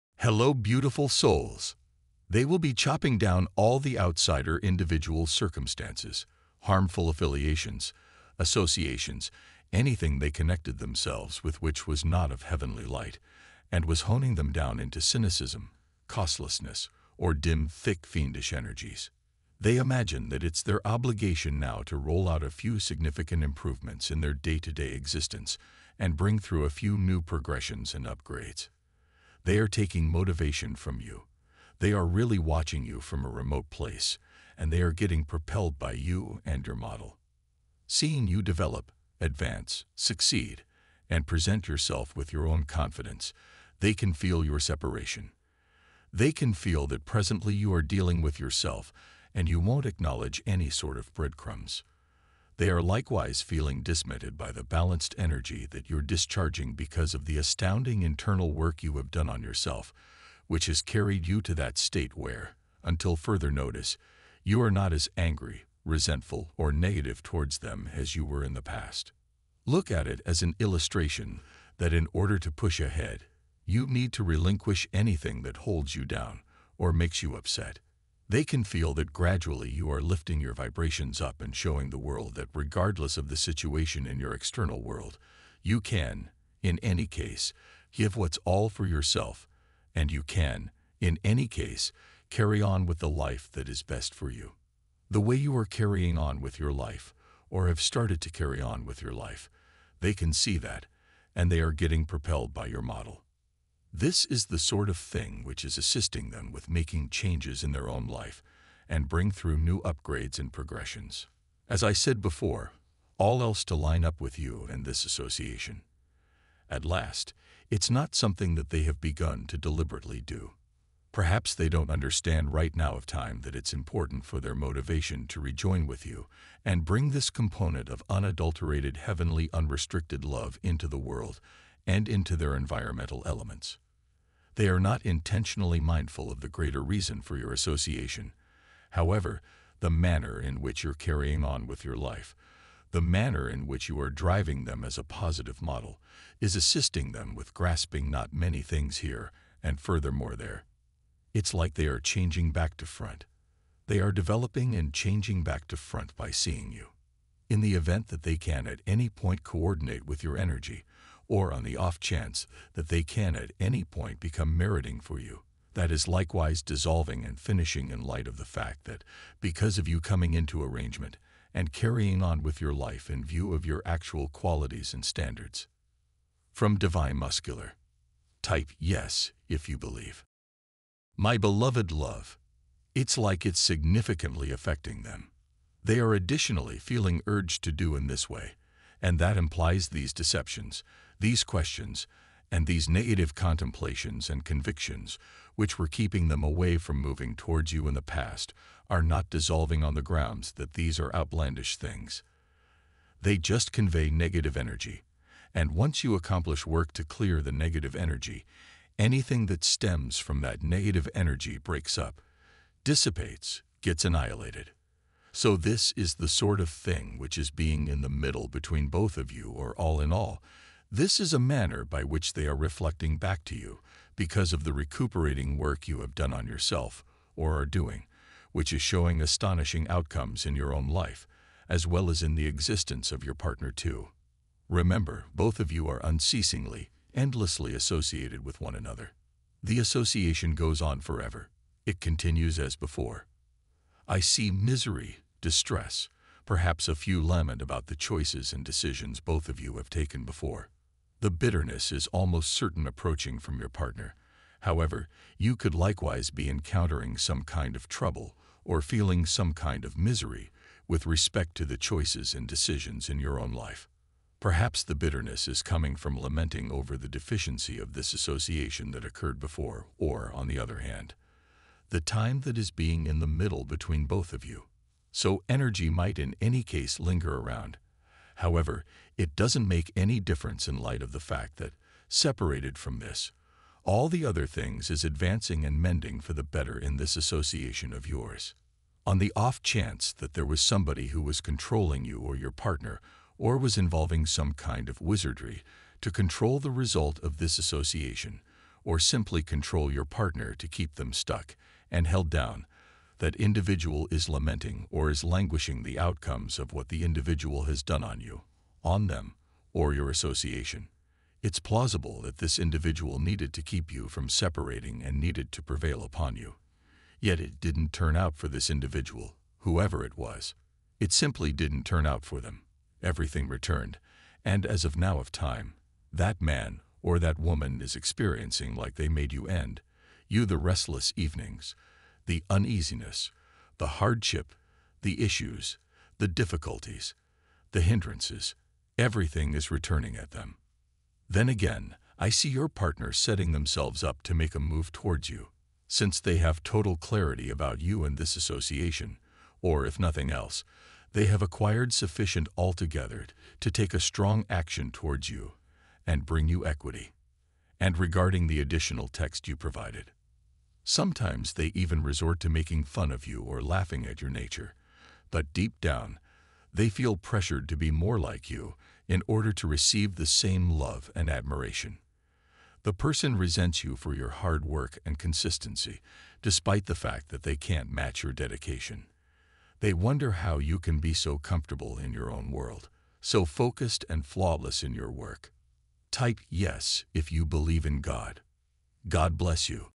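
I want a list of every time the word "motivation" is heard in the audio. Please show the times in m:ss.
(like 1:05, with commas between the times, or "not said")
0:30, 2:04.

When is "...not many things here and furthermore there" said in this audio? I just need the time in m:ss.
2:28.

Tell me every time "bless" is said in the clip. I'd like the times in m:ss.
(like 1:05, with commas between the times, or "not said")
6:29.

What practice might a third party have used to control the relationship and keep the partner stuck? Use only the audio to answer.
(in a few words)
wizardry.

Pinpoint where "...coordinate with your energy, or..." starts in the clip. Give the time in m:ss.
2:39.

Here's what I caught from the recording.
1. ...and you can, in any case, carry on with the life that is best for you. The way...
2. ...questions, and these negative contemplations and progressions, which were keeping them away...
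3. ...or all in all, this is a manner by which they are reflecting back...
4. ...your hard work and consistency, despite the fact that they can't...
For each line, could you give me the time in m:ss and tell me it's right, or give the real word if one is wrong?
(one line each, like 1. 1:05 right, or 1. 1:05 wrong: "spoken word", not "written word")
1. 1:29 right
2. 3:11 wrong: "convictions", not "progressions"
3. 3:39 right
4. 6:14 right.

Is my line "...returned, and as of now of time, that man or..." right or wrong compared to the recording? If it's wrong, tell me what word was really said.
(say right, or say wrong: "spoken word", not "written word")
right.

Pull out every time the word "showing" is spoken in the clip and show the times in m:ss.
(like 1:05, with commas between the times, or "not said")
1:21, 3:48.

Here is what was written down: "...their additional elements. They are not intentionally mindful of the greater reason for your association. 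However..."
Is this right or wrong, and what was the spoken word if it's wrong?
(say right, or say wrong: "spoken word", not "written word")
wrong: "environmental", not "additional".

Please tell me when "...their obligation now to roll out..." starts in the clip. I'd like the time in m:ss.
0:20.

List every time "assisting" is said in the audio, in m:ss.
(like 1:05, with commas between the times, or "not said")
1:45, 2:26.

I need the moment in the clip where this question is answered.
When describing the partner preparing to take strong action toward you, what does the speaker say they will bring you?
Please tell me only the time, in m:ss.
5:56.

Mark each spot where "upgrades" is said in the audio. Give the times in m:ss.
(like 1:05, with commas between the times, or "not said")
0:28, 1:49.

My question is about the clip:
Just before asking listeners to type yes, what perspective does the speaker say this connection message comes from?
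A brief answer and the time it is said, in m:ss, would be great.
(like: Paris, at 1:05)
Divine Masculine, at 2:56.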